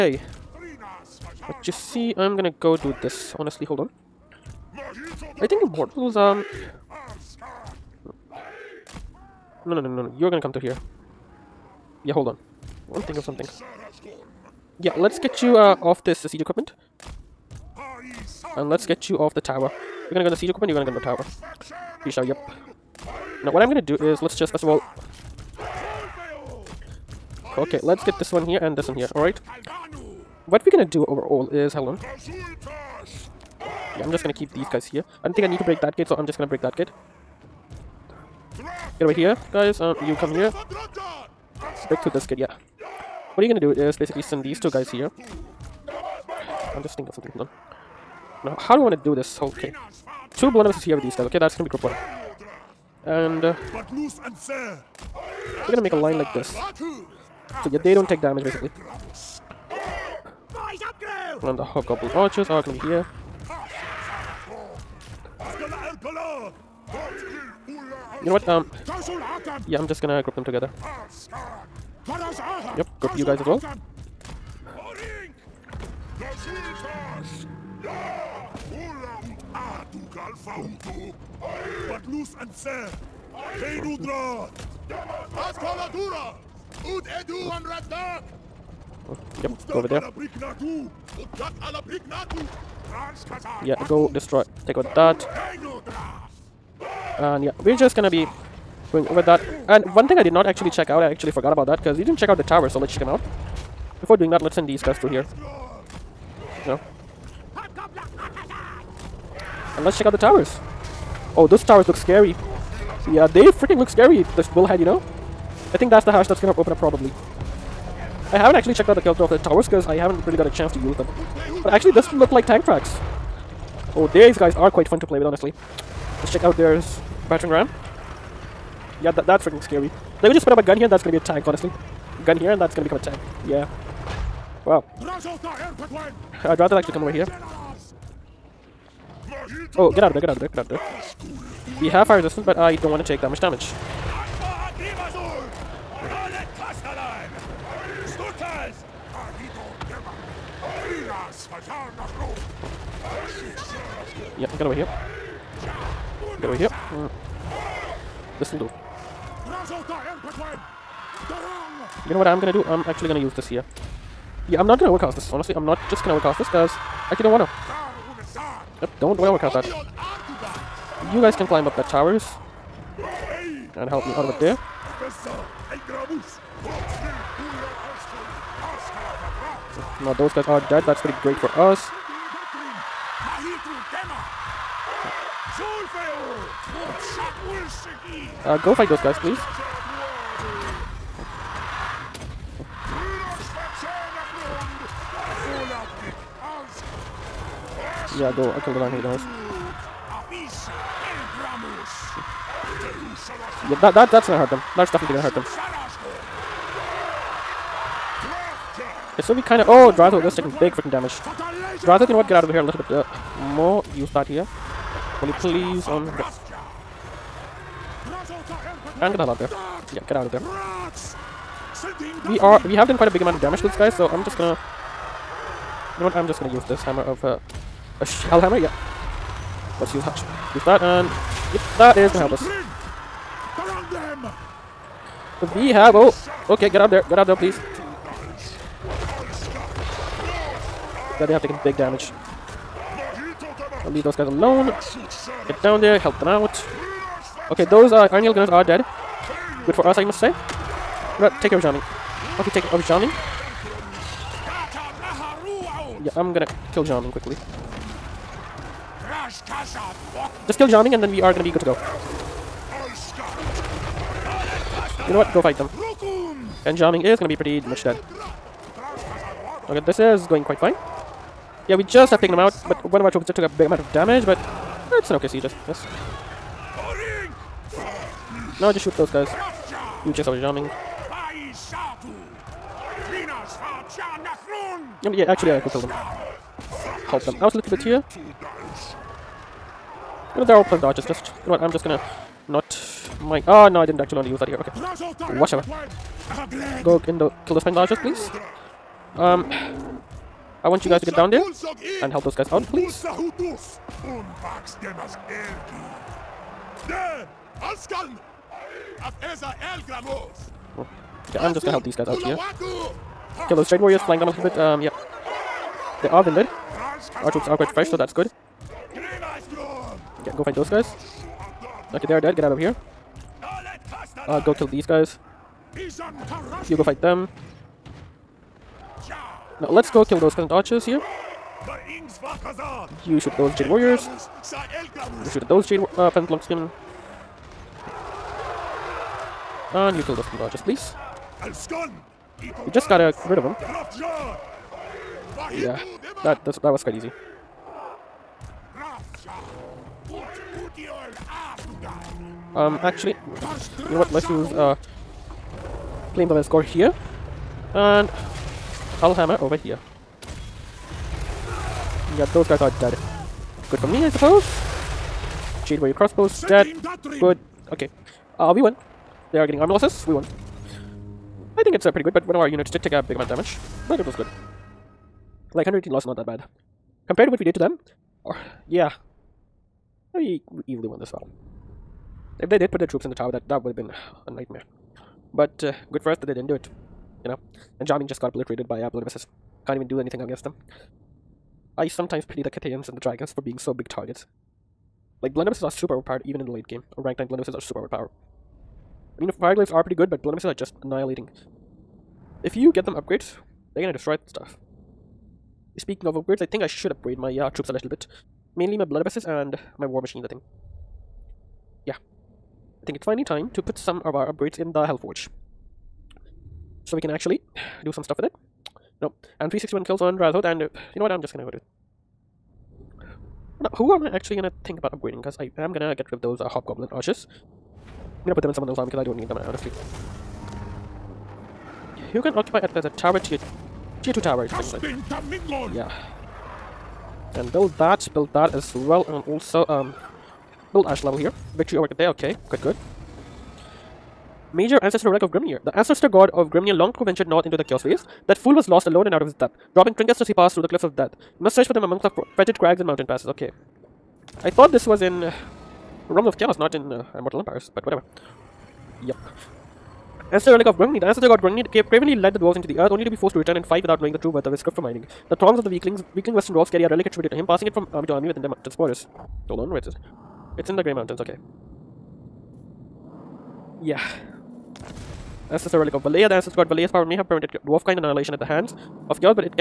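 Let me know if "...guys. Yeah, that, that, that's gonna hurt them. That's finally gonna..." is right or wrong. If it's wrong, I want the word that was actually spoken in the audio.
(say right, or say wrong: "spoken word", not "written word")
wrong: "definitely", not "finally".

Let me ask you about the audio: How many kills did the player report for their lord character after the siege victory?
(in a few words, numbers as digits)
361.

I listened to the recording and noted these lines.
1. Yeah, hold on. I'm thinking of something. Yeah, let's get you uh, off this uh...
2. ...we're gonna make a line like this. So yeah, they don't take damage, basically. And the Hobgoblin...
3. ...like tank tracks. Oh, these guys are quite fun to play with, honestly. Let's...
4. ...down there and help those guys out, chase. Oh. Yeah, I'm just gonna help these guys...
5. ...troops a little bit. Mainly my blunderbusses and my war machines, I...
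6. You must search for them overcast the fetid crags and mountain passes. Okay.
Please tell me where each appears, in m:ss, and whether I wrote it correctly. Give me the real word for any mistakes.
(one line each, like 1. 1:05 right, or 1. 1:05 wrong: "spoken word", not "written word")
1. 0:12 right
2. 0:55 right
3. 2:02 right
4. 5:01 wrong: "please", not "chase"
5. 6:47 right
6. 7:31 wrong: "amongst", not "overcast".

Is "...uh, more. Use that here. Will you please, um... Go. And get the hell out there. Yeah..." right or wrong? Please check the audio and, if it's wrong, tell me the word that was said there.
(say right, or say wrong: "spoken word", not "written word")
right.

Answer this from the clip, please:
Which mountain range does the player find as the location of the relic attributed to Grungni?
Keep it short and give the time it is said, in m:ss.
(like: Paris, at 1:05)
Grey Mountains, at 7:50.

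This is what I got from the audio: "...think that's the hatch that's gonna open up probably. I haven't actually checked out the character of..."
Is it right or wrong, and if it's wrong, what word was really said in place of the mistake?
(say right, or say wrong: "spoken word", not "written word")
right.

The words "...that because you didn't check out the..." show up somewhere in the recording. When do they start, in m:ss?
1:41.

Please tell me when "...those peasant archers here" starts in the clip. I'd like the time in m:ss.
5:30.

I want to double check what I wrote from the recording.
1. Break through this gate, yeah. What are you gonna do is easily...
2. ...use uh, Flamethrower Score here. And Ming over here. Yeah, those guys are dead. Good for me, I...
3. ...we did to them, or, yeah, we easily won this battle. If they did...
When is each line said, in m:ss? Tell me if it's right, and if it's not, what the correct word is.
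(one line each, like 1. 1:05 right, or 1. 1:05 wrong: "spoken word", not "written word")
1. 0:41 wrong: "basically", not "easily"
2. 5:54 wrong: "Hullhammer", not "Ming"
3. 6:17 right.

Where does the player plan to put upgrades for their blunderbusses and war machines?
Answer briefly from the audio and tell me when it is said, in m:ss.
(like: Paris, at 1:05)
The Hellforge, at 6:54.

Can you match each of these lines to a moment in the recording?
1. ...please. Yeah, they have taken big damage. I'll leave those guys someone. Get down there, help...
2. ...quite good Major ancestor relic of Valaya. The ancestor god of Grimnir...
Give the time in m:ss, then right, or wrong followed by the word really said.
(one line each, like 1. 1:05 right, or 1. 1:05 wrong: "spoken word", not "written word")
1. 3:57 wrong: "alone", not "someone"
2. 7:22 wrong: "Grimnir", not "Valaya".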